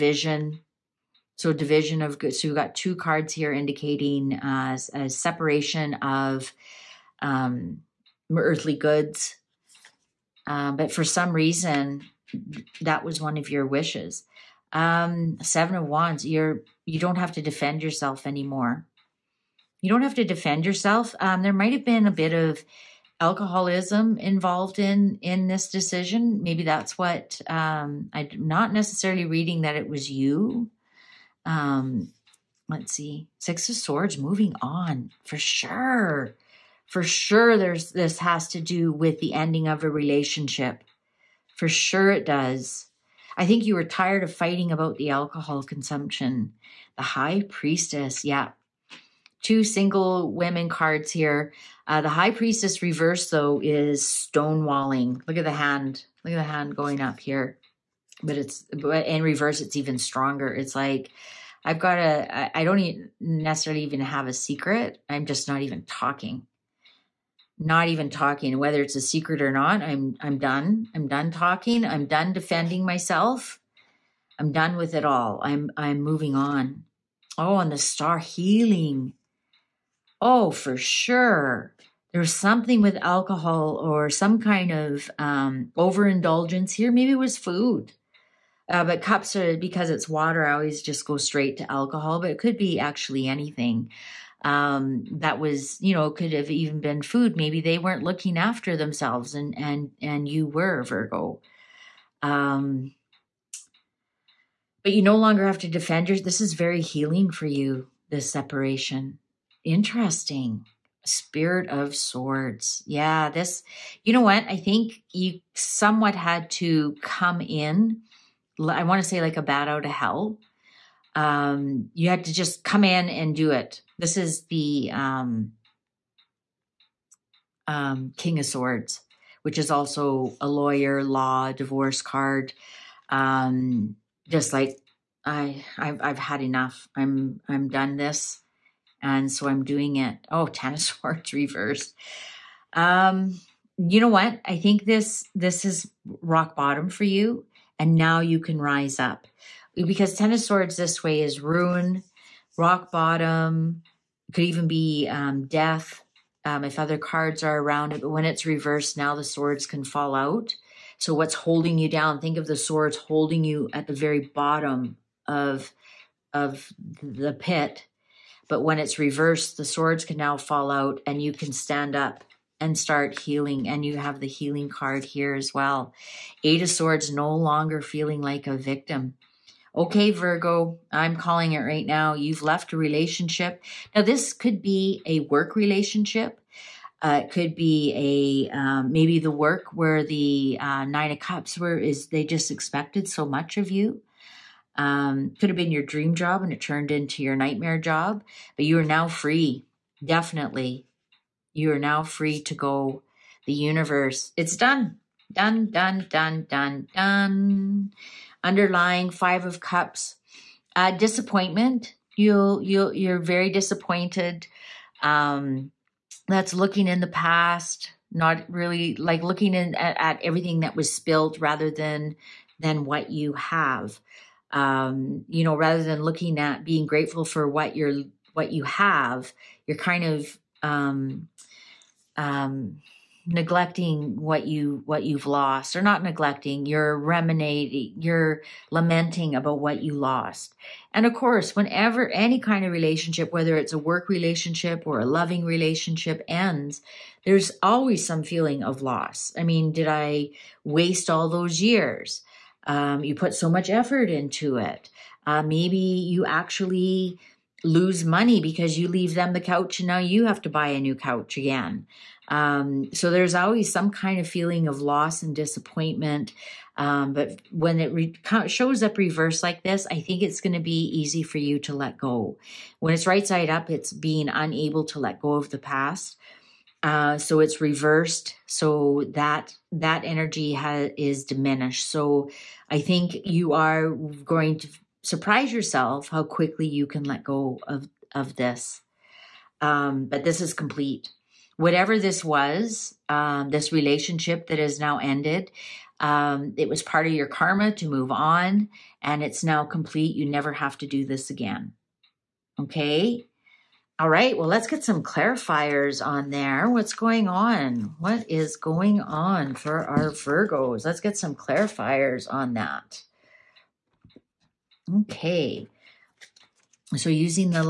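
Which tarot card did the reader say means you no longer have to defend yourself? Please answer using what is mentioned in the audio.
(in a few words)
Seven of Wands.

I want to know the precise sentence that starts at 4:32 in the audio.
When it's right side up, it's being unable to let go of the past.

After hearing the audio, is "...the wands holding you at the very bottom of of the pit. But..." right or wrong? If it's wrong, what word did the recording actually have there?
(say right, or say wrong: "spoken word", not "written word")
wrong: "swords", not "wands".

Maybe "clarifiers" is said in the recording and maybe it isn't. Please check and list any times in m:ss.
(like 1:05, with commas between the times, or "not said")
5:05, 5:11.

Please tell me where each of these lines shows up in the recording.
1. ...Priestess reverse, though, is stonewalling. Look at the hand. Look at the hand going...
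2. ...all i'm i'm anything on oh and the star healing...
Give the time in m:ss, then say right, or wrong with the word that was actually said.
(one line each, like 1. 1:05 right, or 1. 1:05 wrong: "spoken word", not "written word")
1. 0:52 right
2. 1:15 wrong: "moving", not "anything".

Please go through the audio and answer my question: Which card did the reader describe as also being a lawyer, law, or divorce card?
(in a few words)
King of Swords.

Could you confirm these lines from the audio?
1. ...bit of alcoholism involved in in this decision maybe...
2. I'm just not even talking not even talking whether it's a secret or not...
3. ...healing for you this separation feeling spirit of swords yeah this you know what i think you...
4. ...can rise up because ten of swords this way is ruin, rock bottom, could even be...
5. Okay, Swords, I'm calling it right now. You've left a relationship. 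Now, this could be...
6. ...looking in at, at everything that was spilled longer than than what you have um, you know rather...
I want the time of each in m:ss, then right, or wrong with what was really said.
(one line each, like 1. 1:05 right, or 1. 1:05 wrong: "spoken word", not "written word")
1. 0:22 right
2. 1:05 right
3. 1:46 wrong: "interesting", not "feeling"
4. 2:28 right
5. 2:59 wrong: "Virgo", not "Swords"
6. 3:39 wrong: "rather", not "longer".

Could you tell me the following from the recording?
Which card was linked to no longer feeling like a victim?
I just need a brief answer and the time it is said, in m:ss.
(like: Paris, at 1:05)
Eight of Swords, at 2:56.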